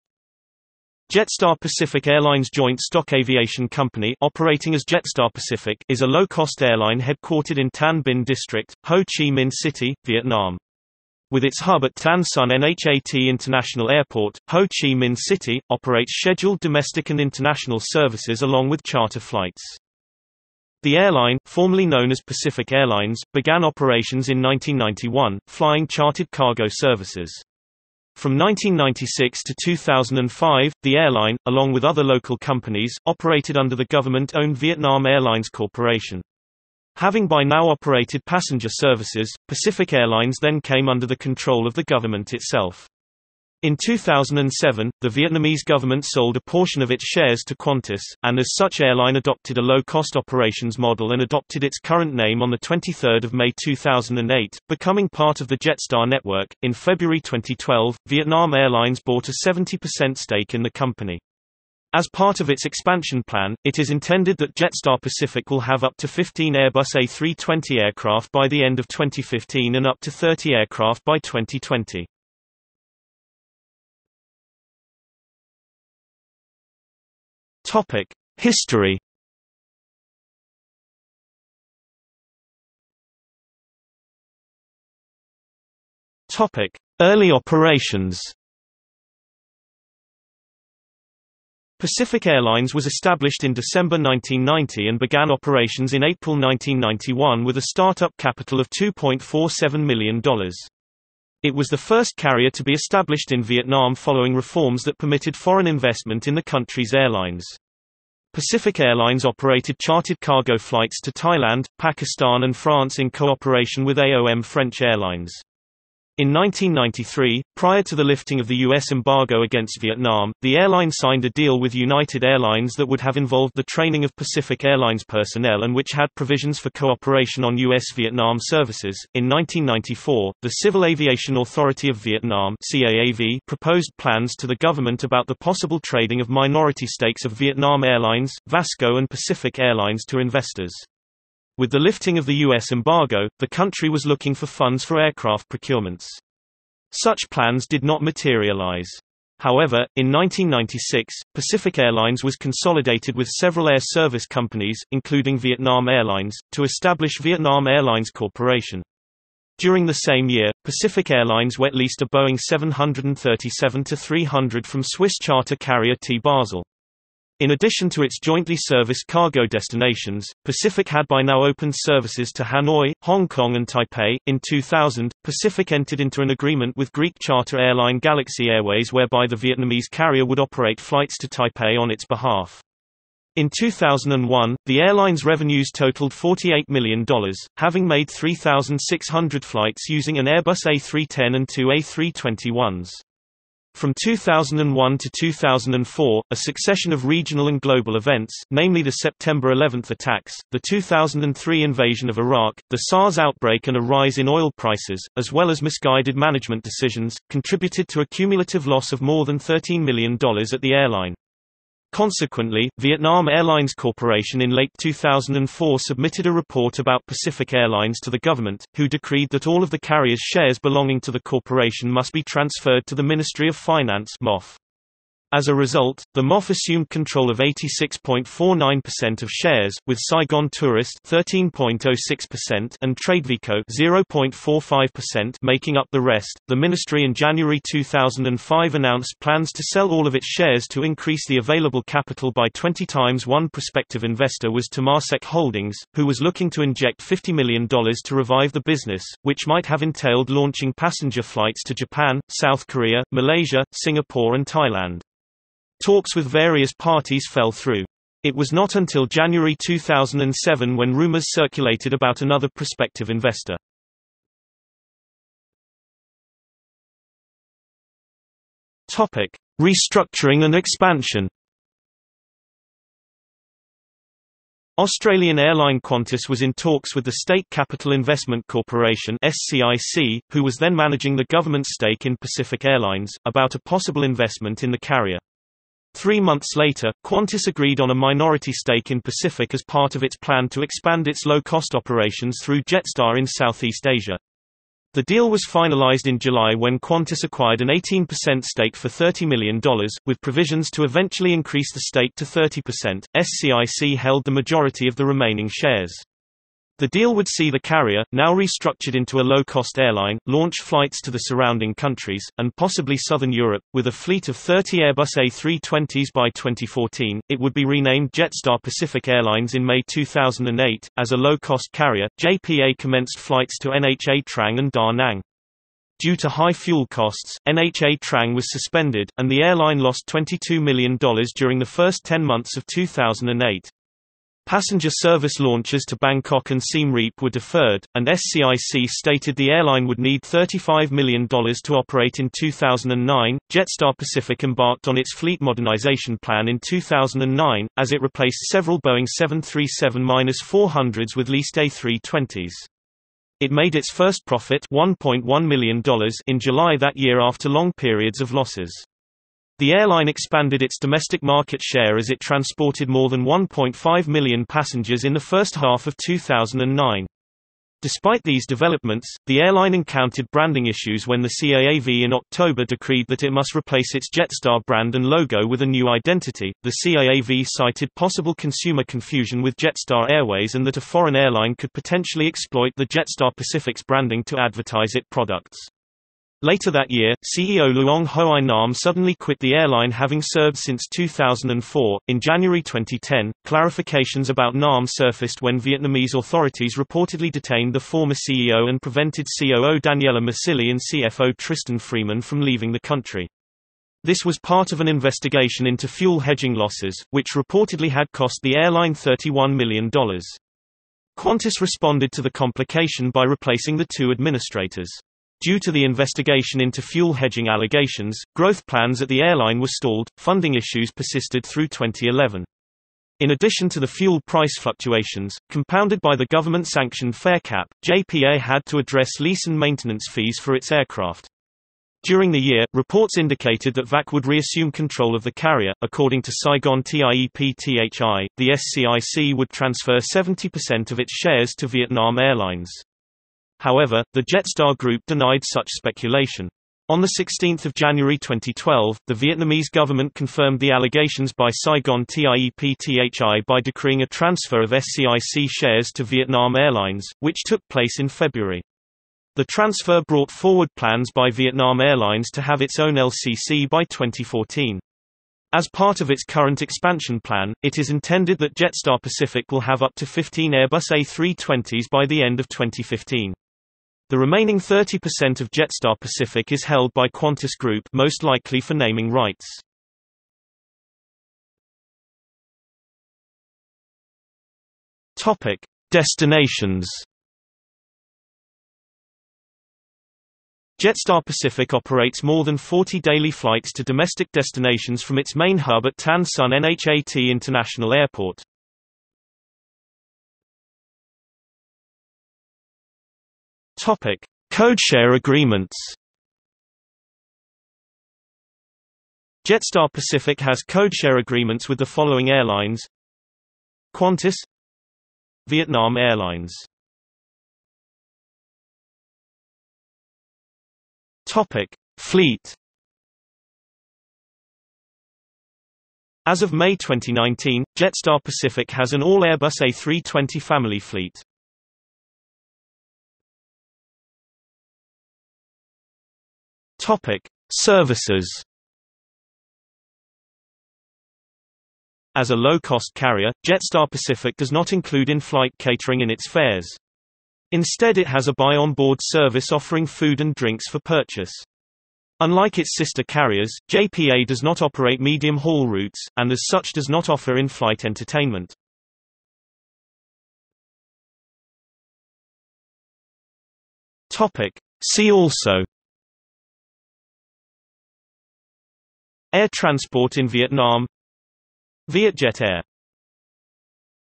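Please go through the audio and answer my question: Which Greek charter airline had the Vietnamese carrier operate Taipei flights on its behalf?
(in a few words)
Galaxy Airways.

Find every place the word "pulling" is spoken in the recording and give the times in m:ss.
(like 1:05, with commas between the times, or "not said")
not said.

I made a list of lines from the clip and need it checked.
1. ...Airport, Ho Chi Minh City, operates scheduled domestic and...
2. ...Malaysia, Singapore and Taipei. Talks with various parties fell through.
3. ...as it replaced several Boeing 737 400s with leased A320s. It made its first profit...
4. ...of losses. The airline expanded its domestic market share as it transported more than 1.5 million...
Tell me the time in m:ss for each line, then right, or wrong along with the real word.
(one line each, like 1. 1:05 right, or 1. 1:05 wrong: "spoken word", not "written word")
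1. 0:13 right
2. 4:13 wrong: "Thailand", not "Taipei"
3. 5:47 right
4. 5:58 right.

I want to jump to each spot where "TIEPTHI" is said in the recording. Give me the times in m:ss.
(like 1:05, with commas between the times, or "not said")
7:16, 7:32.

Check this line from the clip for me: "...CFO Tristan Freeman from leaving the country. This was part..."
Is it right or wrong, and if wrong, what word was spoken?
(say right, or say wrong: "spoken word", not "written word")
right.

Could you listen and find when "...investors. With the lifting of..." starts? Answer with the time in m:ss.
2:20.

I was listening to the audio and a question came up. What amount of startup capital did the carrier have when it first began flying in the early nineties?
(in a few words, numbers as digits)
$2.47 million.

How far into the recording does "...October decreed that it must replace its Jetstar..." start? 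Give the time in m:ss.
6:12.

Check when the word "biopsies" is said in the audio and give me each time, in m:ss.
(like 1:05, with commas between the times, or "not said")
not said.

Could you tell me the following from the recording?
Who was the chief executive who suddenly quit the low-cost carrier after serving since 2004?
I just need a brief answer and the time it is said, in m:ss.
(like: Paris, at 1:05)
Luong Hoai Nam, at 6:27.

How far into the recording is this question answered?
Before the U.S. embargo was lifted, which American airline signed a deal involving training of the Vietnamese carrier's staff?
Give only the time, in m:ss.
2:01.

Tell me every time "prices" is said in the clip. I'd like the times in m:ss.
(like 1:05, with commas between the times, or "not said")
3:24, 7:04.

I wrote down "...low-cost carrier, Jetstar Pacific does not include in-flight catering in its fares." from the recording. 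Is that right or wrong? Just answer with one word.
right.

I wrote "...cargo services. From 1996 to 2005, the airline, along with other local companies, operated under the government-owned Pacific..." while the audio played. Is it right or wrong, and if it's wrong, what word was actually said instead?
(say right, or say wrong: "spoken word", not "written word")
wrong: "Vietnam", not "Pacific".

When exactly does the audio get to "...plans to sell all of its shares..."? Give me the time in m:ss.
3:59.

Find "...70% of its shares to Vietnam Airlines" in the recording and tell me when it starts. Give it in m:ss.
7:20.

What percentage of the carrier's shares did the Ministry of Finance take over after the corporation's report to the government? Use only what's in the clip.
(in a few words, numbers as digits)
86.49%.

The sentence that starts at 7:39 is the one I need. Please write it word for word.
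The transfer brought forward plans by Vietnam Airlines to have its own LCC by 2014.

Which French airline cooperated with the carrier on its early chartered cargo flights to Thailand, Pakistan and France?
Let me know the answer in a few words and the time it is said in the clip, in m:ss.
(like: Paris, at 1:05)
AOM French Airlines, at 1:53.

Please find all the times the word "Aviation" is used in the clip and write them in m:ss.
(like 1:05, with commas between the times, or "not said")
0:03, 2:10.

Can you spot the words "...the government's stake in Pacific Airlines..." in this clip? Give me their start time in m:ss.
4:41.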